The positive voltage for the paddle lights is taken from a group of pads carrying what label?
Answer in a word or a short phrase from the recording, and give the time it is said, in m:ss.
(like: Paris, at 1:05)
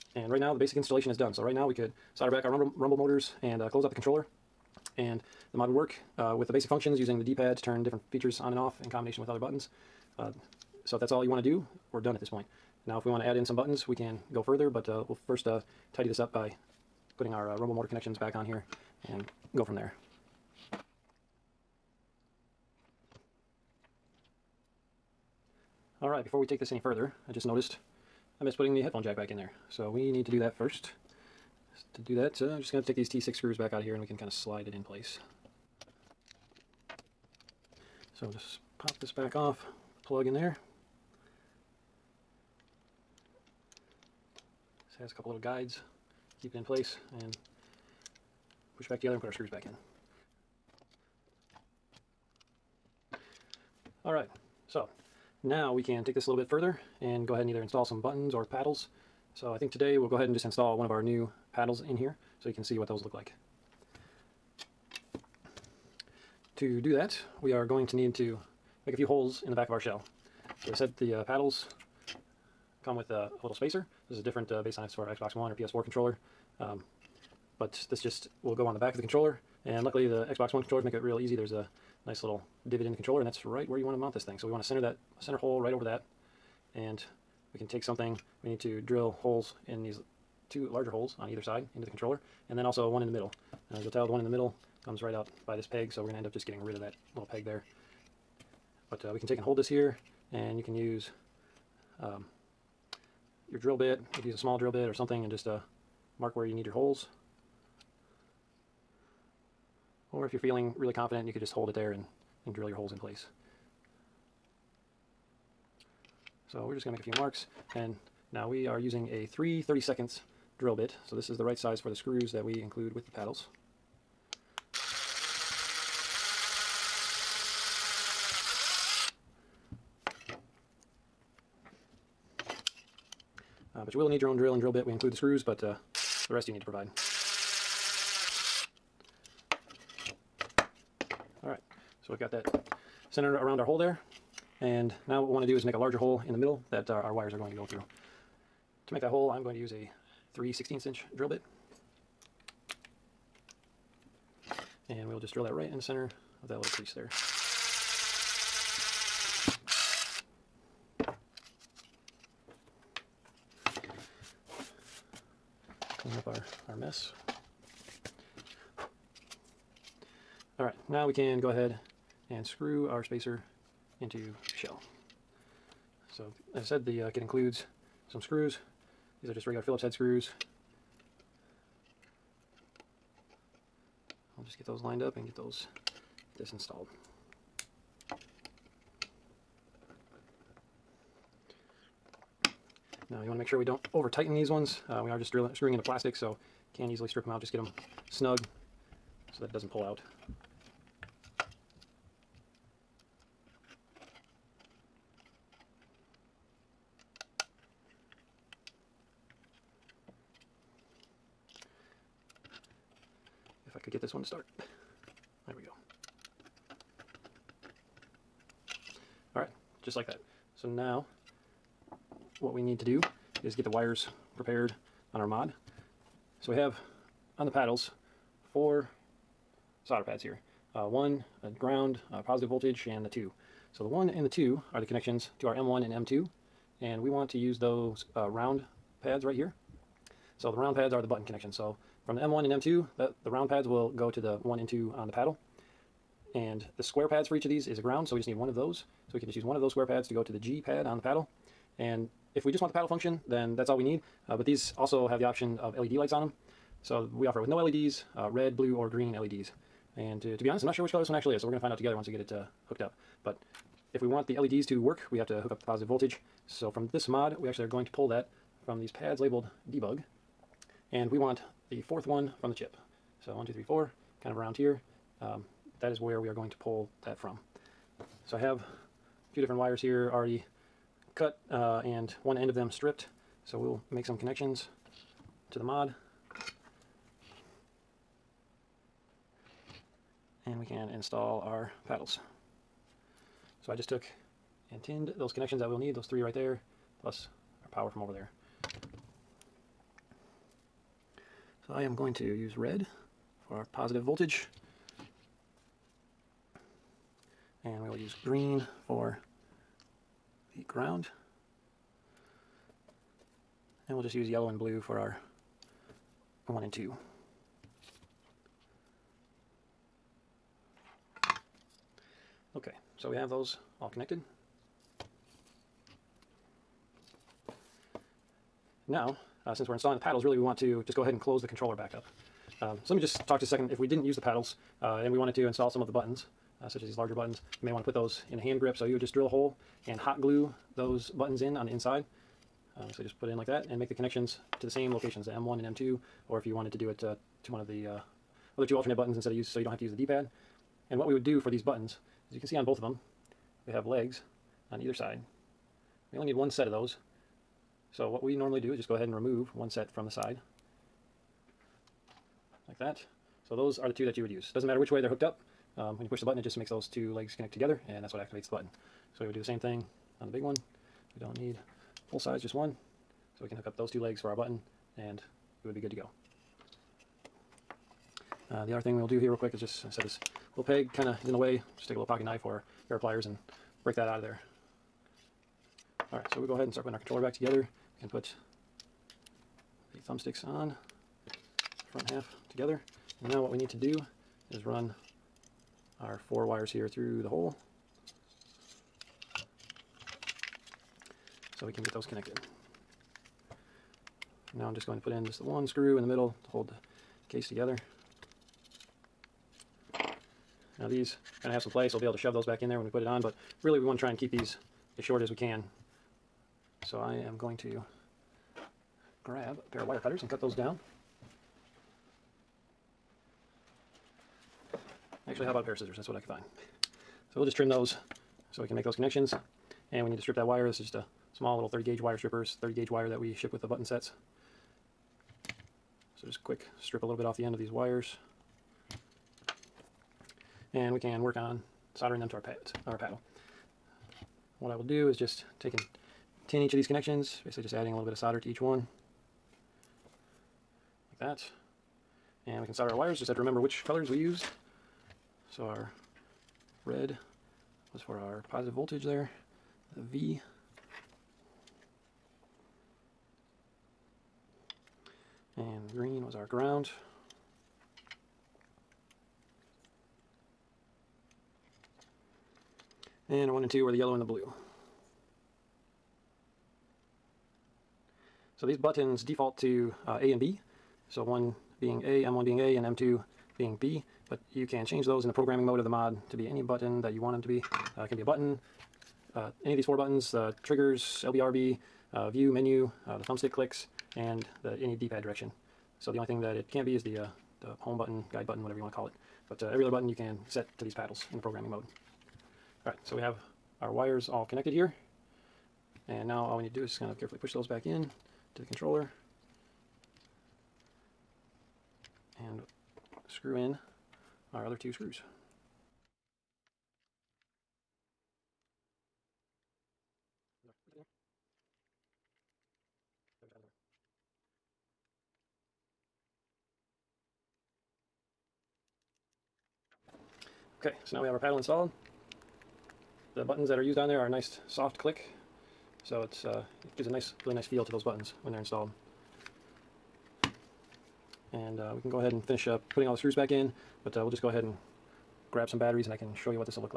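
debug, at 4:29.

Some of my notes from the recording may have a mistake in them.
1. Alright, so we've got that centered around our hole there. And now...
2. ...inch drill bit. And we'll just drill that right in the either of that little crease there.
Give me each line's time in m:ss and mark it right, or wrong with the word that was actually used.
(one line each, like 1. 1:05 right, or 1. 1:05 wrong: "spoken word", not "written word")
1. 2:21 right
2. 2:30 wrong: "center", not "either".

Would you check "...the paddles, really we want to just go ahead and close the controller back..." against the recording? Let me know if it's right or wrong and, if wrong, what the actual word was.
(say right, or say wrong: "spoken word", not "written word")
right.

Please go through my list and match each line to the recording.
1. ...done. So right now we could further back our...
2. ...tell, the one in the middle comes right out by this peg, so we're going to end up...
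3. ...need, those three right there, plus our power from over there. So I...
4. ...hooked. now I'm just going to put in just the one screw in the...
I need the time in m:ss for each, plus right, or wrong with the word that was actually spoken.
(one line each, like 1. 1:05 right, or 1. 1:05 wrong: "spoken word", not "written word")
1. 0:01 wrong: "solder", not "further"
2. 1:33 right
3. 4:55 right
4. 6:42 wrong: "connected", not "hooked".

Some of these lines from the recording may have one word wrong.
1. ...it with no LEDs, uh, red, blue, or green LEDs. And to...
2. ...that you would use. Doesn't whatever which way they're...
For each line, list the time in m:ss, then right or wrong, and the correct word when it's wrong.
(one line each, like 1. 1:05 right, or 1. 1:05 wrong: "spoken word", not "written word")
1. 4:17 right
2. 6:04 wrong: "matter", not "whatever".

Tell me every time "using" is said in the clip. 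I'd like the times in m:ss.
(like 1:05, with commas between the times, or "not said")
0:06, 1:58.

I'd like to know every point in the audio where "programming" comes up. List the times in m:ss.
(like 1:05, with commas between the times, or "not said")
8:05, 8:21.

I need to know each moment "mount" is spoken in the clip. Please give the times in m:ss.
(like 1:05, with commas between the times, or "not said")
1:23.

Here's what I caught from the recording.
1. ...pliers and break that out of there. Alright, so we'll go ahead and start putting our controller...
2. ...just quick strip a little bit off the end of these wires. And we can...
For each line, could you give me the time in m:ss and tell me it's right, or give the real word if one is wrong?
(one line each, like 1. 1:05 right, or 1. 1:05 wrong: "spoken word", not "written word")
1. 6:23 right
2. 7:16 right.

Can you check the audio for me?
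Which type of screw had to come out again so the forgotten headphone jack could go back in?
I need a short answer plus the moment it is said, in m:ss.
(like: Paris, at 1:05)
T6, at 0:33.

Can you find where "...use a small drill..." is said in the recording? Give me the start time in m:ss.
1:44.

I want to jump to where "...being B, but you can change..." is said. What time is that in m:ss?
8:03.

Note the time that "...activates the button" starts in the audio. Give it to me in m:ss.
6:08.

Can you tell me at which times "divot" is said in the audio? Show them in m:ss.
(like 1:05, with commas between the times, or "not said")
1:22.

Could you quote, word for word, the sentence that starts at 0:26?
Alright, before we take this any further, I just noticed I missed putting the headphone jack back in there.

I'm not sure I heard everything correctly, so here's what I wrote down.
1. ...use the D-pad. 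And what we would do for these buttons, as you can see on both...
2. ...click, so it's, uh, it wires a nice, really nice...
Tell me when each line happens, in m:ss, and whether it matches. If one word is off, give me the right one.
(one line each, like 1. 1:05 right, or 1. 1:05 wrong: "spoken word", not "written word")
1. 5:49 right
2. 8:54 wrong: "gives", not "wires".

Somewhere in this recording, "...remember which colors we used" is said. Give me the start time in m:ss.
7:33.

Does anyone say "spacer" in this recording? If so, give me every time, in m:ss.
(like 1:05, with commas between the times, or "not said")
1:13, 2:53.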